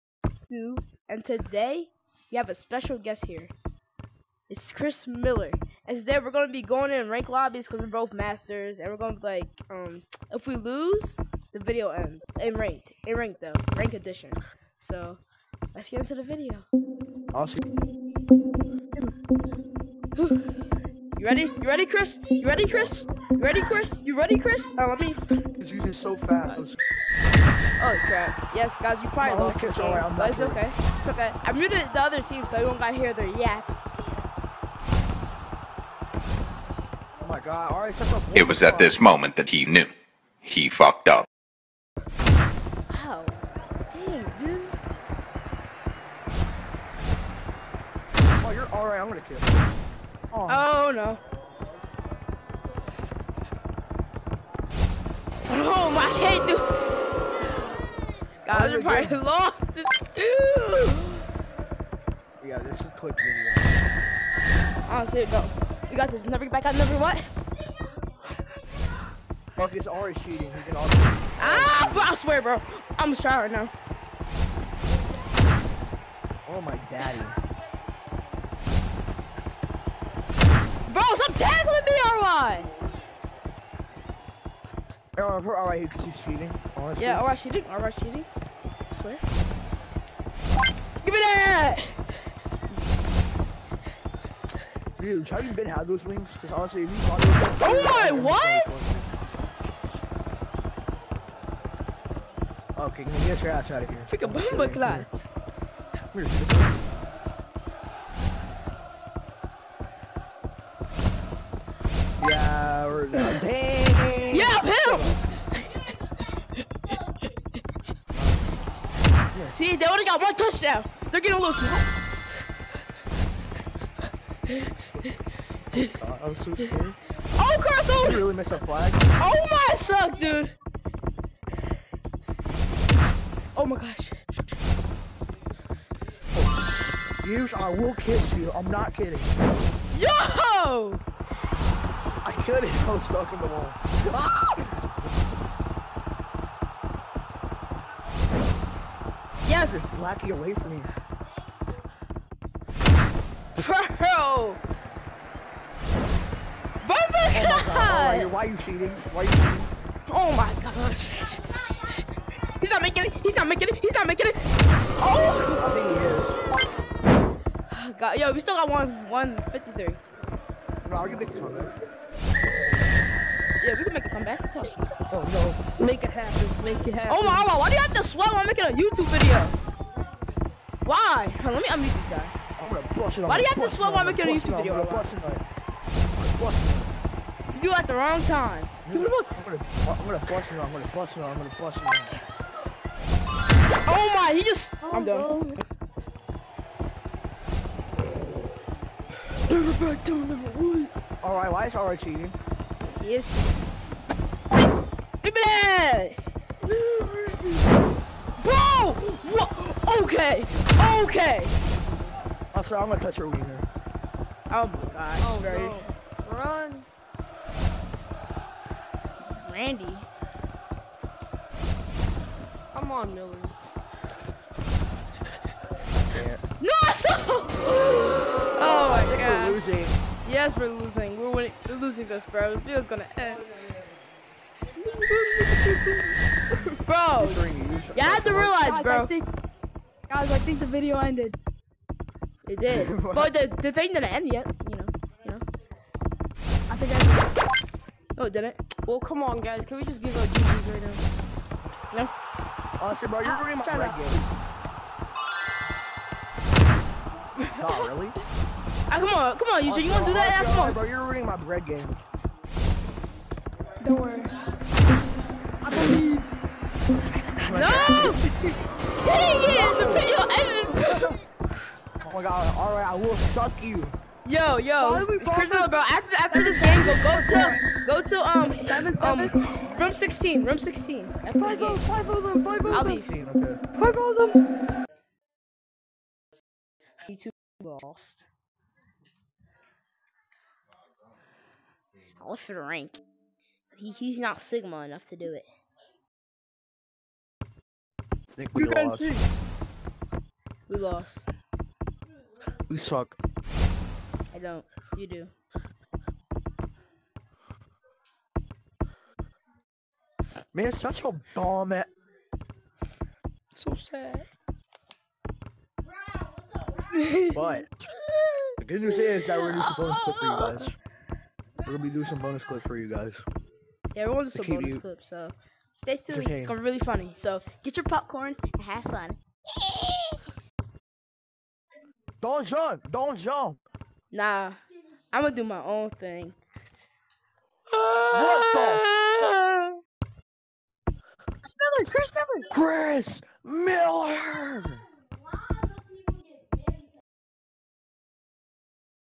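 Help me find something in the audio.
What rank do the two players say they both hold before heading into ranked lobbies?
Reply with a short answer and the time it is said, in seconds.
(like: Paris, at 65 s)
Masters, at 8 s.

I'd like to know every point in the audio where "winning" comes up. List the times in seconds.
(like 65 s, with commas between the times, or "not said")
231 s.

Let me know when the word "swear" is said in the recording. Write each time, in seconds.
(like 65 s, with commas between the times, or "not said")
72 s, 88 s, 178 s, 183 s.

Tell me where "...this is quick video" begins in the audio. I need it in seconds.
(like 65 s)
62 s.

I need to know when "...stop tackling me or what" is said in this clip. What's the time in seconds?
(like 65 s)
81 s.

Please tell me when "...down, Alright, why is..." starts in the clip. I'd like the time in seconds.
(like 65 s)
200 s.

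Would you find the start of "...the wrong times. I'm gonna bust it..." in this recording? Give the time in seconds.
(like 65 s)
187 s.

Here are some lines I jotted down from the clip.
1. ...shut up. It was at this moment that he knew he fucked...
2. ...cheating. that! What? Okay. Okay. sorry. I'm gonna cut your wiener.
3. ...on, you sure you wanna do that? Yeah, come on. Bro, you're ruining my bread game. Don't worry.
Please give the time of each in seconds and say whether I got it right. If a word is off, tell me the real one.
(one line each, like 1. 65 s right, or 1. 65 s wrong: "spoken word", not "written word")
1. 37 s right
2. 205 s right
3. 259 s right.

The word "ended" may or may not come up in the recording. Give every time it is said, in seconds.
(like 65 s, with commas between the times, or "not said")
240 s, 270 s.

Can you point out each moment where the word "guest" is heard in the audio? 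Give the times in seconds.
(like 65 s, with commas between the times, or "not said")
2 s.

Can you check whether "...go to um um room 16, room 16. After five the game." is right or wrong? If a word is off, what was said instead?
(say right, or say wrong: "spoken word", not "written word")
right.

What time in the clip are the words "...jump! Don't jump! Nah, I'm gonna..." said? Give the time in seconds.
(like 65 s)
332 s.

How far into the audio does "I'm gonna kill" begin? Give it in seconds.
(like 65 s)
48 s.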